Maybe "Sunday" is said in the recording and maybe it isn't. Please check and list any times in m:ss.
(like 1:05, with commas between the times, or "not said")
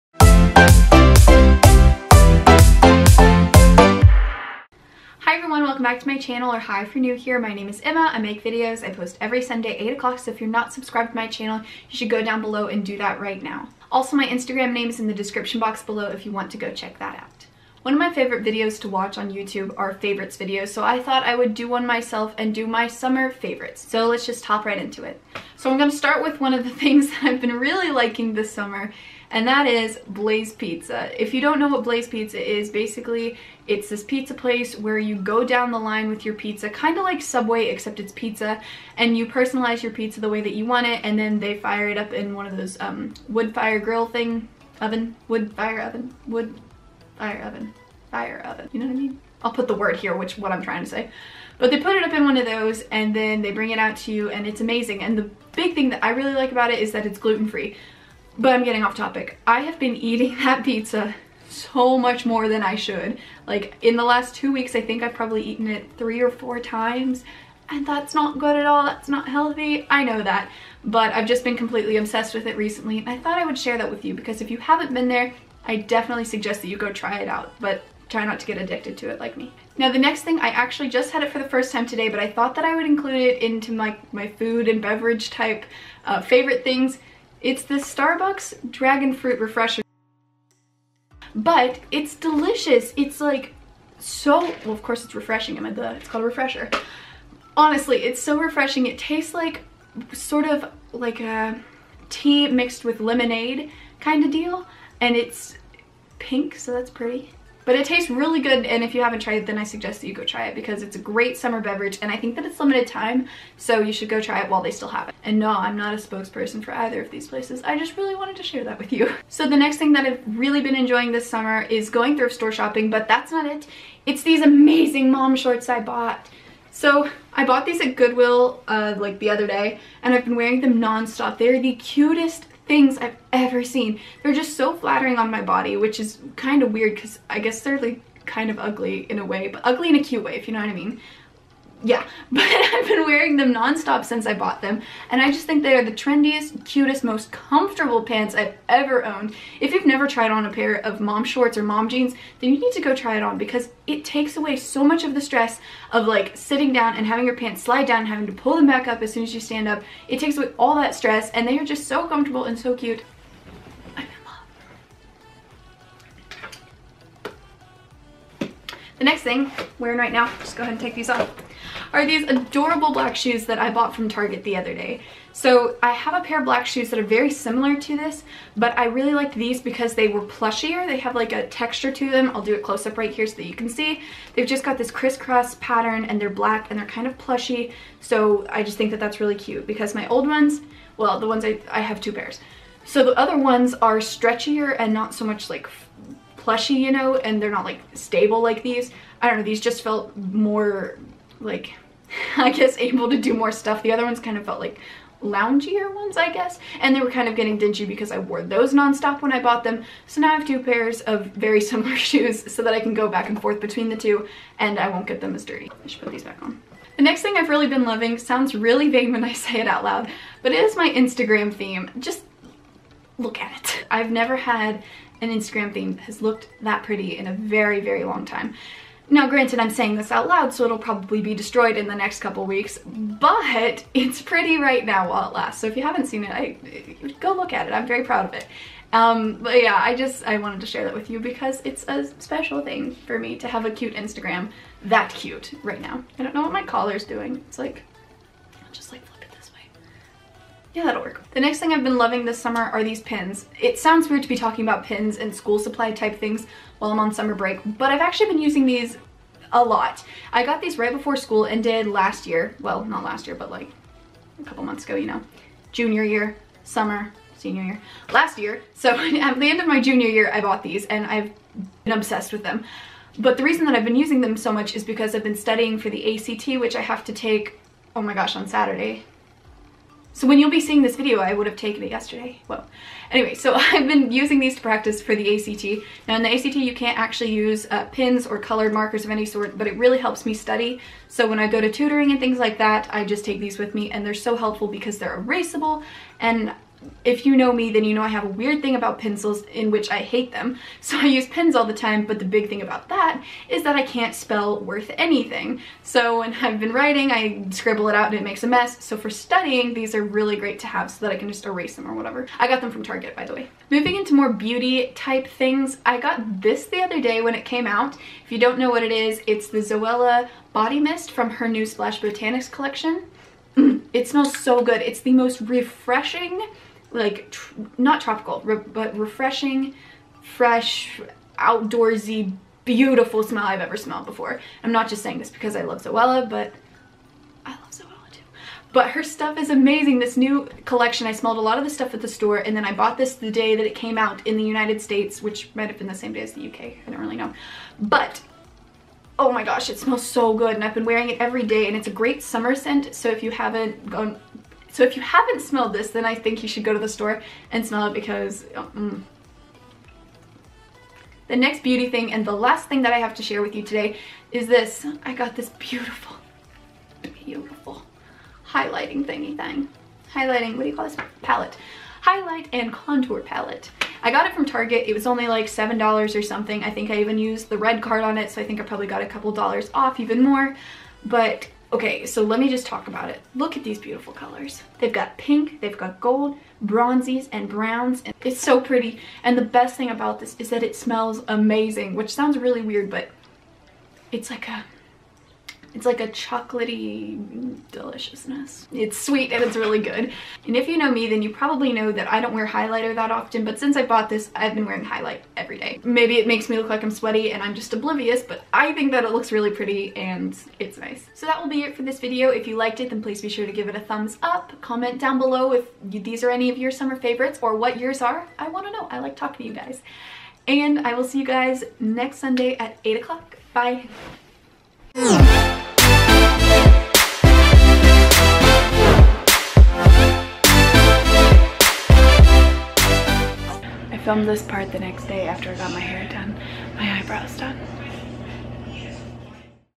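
0:09, 7:02.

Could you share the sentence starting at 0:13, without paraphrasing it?
Also my Instagram name is in the description box below if you want to go check that out.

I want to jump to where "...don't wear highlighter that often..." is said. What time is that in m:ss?
6:42.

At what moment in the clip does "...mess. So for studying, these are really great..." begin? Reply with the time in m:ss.
5:08.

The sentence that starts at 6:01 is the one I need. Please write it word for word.
The next beauty thing and the last thing that I have to share with you today is this.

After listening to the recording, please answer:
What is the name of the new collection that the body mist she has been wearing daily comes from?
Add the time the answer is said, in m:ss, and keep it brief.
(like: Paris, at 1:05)
Splash Botanics, at 5:21.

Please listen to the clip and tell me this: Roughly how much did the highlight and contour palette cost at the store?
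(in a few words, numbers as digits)
$7.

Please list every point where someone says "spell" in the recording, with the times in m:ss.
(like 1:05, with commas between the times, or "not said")
5:04.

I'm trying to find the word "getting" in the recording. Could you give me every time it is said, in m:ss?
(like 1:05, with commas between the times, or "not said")
0:58, 3:27.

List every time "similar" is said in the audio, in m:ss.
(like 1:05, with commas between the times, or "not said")
2:57, 3:31.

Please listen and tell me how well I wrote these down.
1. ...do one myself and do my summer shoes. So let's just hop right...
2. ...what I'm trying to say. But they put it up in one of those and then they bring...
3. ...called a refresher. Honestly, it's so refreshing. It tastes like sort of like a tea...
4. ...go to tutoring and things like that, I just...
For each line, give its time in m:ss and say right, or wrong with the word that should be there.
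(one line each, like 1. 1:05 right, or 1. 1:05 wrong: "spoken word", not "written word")
1. 0:21 wrong: "favorites", not "shoes"
2. 0:50 right
3. 1:36 right
4. 4:51 right.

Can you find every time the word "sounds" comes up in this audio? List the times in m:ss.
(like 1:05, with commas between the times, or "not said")
3:38, 4:13, 6:32.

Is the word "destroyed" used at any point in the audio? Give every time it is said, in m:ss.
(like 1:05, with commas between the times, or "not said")
3:51.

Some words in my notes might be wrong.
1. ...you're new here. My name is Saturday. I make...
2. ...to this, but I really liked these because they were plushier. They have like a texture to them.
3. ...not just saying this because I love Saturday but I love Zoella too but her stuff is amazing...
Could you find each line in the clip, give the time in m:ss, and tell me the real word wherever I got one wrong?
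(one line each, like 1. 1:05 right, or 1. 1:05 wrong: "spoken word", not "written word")
1. 0:06 wrong: "Emma", not "Saturday"
2. 2:57 right
3. 5:34 wrong: "Zoella", not "Saturday".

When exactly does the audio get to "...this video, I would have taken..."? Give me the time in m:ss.
4:40.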